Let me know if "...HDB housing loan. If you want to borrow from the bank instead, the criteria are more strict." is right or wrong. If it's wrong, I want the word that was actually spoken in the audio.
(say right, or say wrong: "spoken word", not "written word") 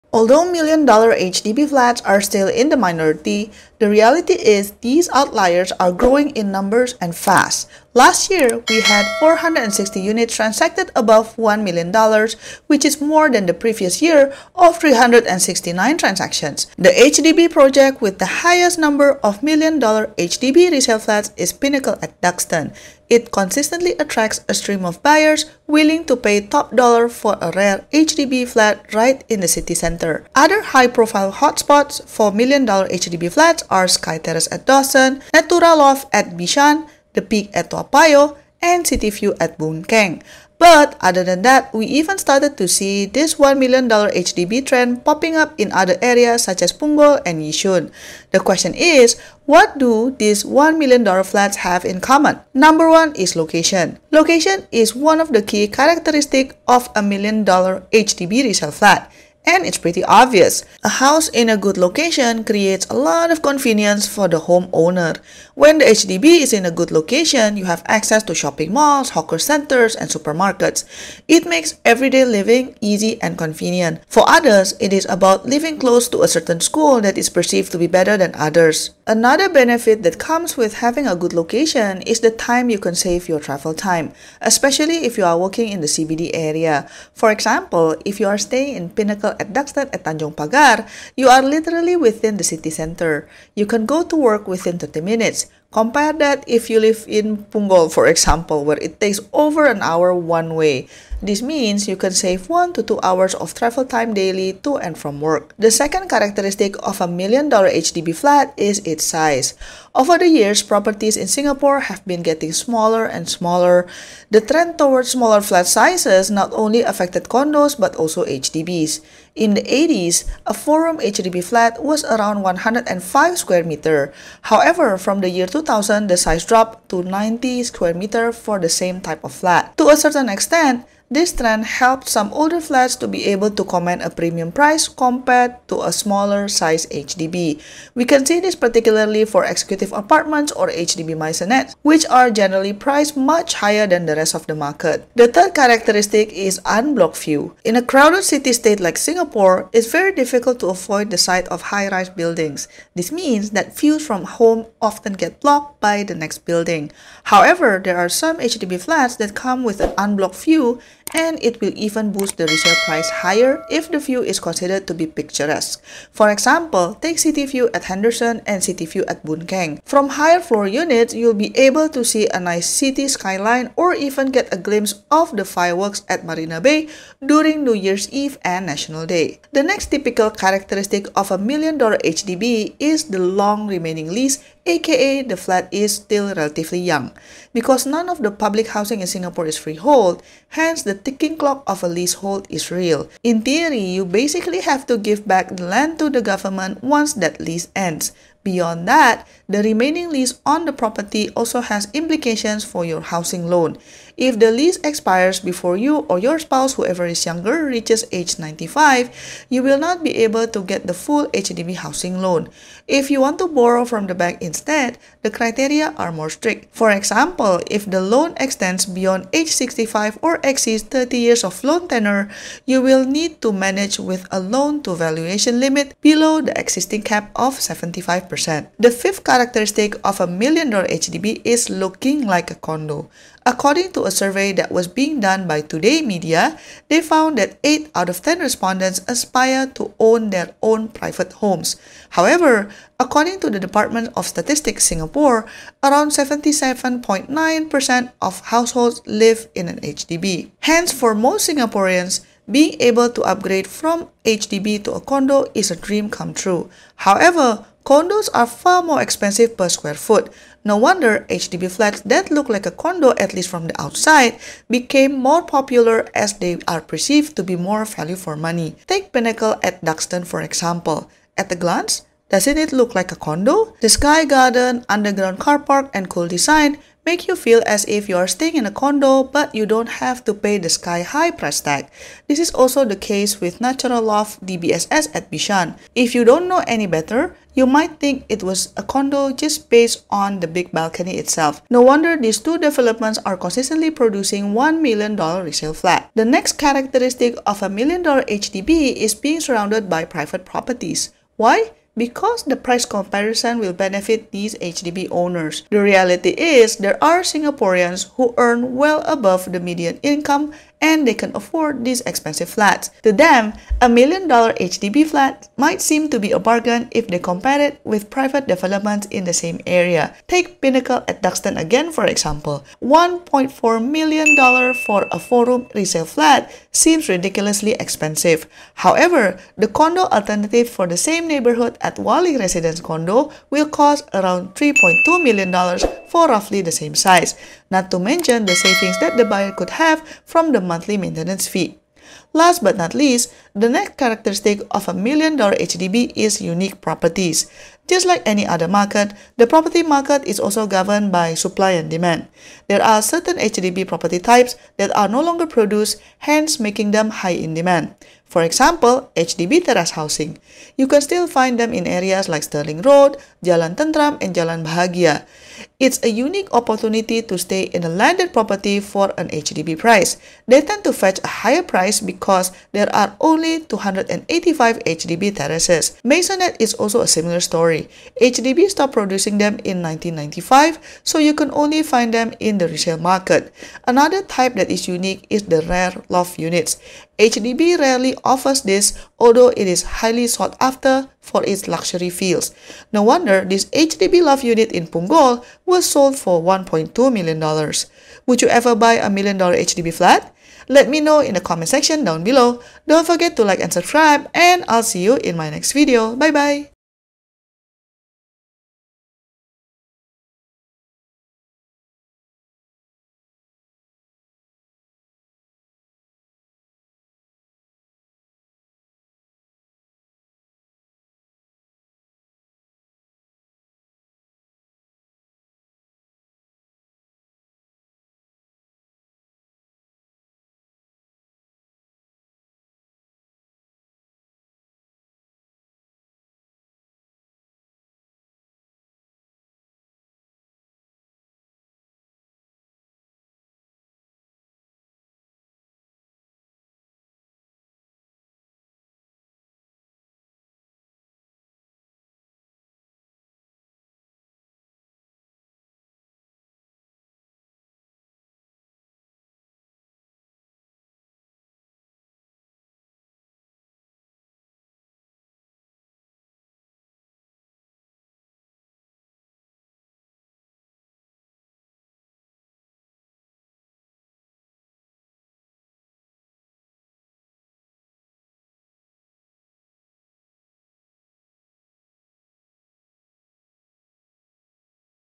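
right.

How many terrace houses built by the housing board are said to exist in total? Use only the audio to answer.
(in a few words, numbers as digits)
285.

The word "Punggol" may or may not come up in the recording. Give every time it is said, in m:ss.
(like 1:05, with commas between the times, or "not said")
0:46, 1:37, 6:34.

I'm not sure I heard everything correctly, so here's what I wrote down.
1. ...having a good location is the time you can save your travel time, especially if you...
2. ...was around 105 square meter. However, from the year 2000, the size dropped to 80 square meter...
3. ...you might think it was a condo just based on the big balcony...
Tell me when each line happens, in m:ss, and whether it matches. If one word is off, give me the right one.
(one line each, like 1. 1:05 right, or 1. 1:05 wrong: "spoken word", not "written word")
1. 1:20 right
2. 2:01 wrong: "90", not "80"
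3. 4:47 right.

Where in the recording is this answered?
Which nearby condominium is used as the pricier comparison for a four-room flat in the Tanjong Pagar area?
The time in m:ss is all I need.
5:31.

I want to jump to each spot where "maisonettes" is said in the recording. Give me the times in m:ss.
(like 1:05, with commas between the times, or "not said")
2:21, 6:16.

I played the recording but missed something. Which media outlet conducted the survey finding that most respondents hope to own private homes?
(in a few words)
Today Media.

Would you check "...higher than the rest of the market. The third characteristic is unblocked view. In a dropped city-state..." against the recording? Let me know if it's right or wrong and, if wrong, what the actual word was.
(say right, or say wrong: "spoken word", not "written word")
wrong: "crowded", not "dropped".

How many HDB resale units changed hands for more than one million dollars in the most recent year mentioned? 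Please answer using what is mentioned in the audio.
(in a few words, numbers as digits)
460.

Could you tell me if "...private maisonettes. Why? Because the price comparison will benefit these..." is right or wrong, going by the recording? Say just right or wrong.
wrong.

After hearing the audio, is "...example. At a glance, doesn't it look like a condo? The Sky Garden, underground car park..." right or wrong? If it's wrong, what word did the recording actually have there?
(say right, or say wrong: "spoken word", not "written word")
right.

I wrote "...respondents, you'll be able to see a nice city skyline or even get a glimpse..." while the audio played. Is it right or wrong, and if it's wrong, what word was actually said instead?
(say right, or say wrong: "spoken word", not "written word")
wrong: "units", not "respondents".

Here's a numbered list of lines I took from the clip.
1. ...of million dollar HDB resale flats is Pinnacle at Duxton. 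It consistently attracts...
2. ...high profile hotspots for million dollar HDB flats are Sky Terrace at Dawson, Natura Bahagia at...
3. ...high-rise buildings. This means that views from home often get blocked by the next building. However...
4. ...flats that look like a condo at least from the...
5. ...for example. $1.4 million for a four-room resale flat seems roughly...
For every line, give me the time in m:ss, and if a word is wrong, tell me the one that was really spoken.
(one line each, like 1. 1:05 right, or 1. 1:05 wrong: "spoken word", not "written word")
1. 0:19 right
2. 0:30 wrong: "Loft", not "Bahagia"
3. 2:31 right
4. 4:21 right
5. 5:21 wrong: "ridiculously", not "roughly".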